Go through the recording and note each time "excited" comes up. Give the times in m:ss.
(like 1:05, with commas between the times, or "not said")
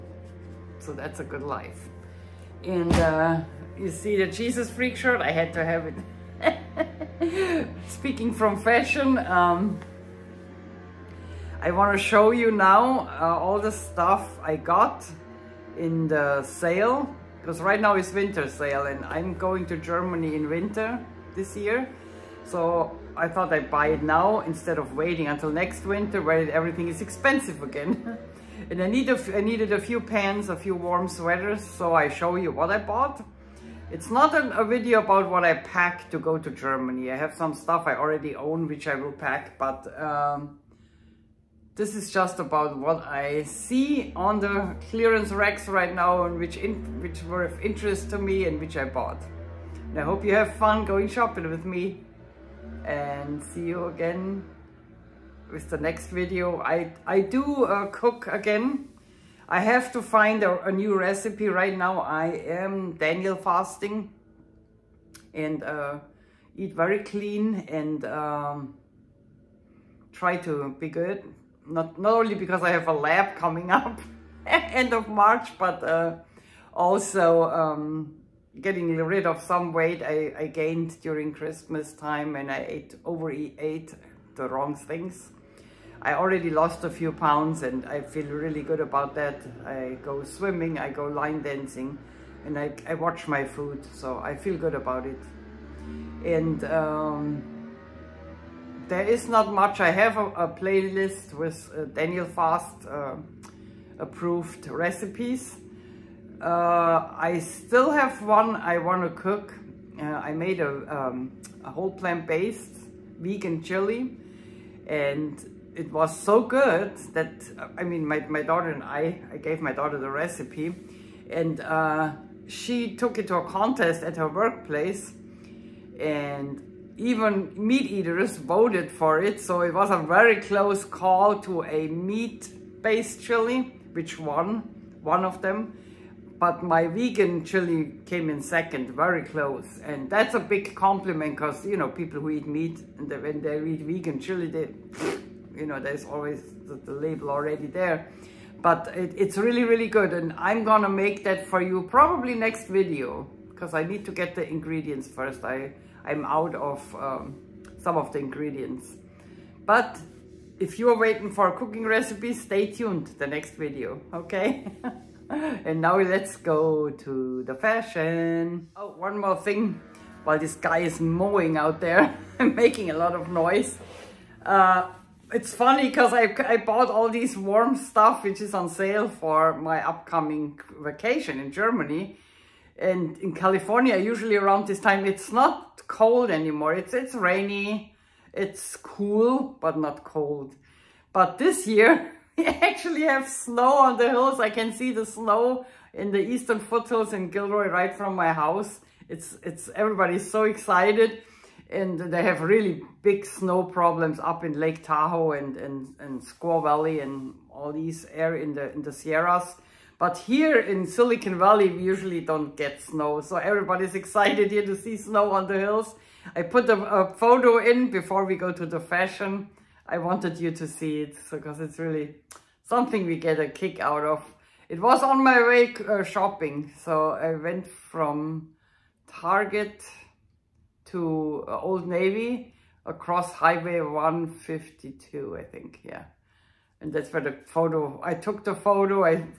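3:20, 3:34.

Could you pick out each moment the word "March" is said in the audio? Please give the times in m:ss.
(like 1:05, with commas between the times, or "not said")
1:15.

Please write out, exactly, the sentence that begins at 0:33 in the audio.
It's not an, a video about what I pack to go to Germany.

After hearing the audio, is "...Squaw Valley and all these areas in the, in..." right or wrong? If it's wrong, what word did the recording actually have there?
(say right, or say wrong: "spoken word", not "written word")
right.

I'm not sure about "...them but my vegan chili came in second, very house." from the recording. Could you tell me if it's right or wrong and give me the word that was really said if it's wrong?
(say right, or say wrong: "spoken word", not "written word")
wrong: "close", not "house".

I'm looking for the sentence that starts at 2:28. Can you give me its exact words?
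But it, it's really, really good.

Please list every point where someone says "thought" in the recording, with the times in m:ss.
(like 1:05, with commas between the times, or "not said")
0:23.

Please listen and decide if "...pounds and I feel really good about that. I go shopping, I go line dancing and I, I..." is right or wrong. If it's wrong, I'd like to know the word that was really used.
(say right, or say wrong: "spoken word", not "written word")
wrong: "swimming", not "shopping".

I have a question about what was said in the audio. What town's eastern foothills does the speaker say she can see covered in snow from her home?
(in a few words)
Gilroy.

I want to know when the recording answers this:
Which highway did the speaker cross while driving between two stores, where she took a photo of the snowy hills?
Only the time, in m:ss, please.
3:53.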